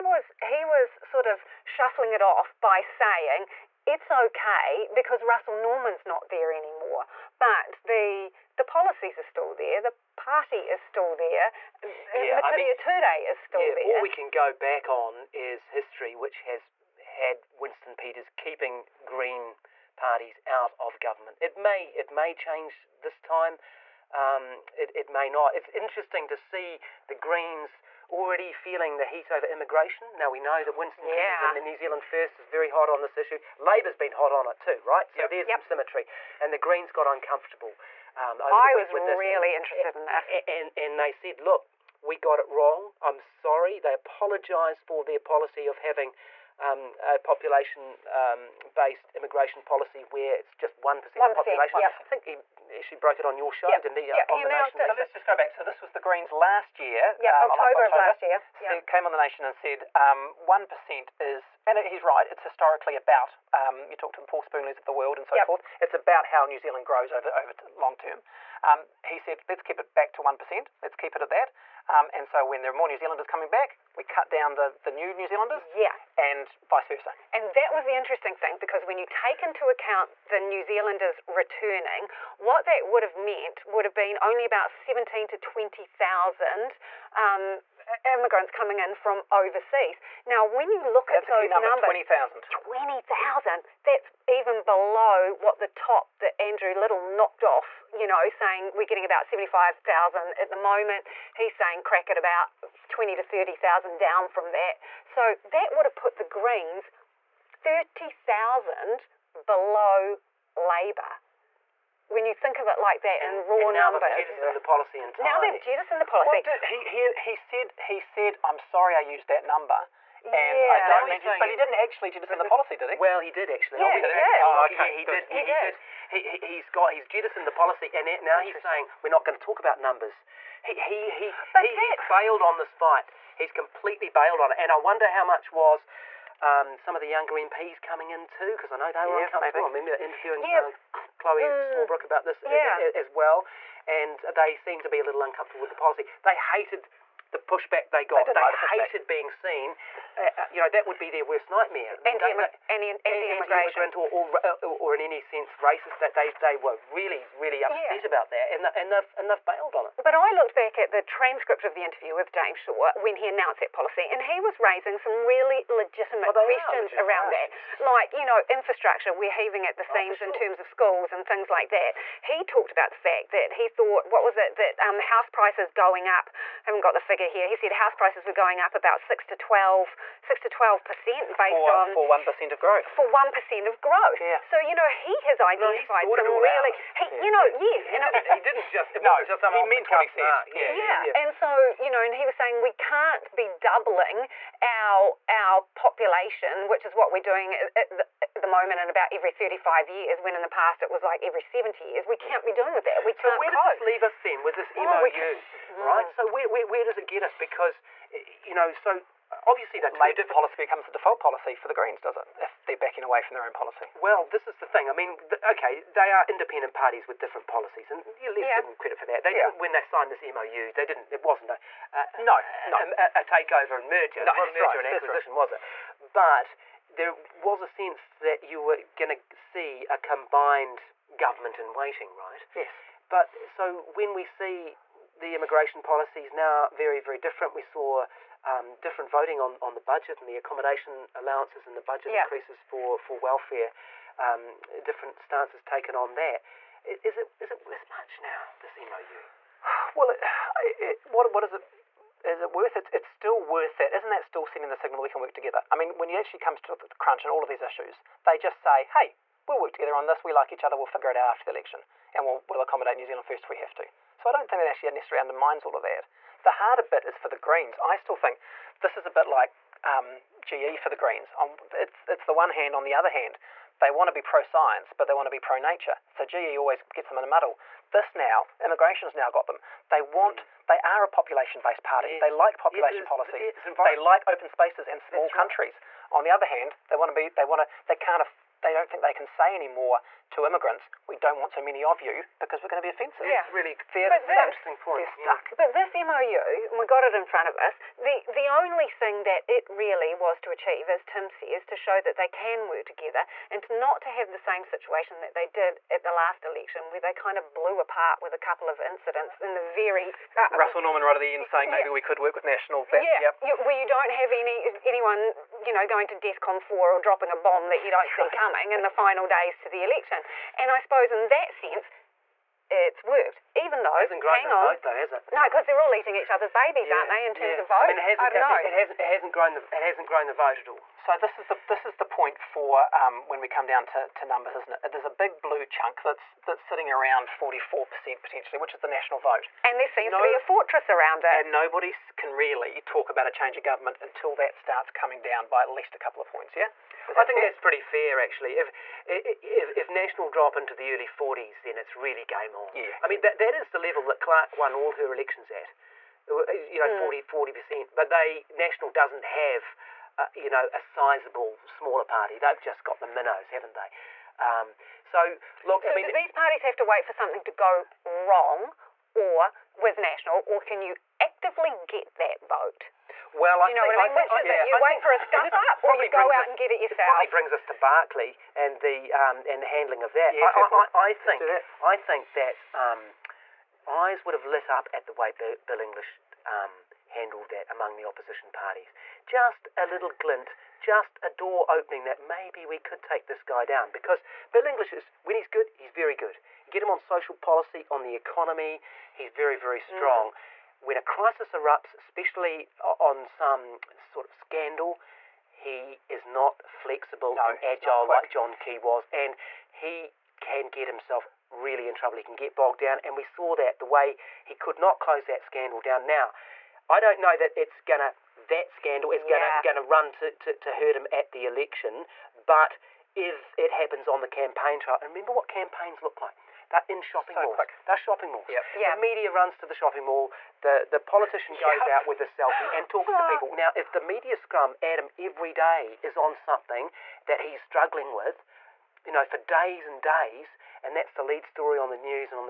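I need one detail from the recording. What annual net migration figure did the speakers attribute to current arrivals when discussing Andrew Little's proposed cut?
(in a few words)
75,000.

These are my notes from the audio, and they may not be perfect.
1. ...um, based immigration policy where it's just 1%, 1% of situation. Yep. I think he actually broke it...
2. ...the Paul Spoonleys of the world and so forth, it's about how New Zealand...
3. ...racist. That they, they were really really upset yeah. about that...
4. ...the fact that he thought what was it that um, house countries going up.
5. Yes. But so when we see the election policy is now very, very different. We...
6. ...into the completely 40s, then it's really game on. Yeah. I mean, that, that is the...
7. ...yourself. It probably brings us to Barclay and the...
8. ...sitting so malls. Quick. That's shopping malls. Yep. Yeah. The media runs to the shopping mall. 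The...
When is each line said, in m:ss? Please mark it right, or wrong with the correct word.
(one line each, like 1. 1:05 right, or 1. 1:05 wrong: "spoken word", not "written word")
1. 0:48 wrong: "population", not "situation"
2. 1:04 right
3. 2:35 right
4. 2:52 wrong: "prices", not "countries"
5. 3:52 wrong: "immigration", not "election"
6. 5:50 wrong: "early", not "completely"
7. 6:16 right
8. 7:07 wrong: "shopping", not "sitting".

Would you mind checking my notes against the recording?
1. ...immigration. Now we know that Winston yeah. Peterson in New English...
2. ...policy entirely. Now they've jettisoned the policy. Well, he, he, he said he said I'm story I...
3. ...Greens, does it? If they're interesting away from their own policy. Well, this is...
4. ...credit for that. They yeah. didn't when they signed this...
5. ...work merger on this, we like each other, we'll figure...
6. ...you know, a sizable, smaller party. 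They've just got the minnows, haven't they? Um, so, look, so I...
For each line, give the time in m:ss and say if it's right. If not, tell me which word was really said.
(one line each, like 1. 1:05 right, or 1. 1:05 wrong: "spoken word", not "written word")
1. 0:29 wrong: "Zealand", not "English"
2. 1:54 wrong: "sorry", not "story"
3. 3:31 wrong: "backing", not "interesting"
4. 3:38 right
5. 4:19 wrong: "together", not "merger"
6. 6:00 right.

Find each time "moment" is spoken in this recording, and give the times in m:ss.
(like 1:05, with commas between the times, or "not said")
1:40, 3:18.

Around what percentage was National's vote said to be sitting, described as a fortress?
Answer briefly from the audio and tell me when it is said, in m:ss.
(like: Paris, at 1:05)
44 percent, at 5:37.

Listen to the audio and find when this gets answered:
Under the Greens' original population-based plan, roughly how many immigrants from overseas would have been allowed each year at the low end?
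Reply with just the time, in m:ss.
1:24.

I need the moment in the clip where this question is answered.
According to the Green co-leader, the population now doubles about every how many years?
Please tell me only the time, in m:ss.
3:19.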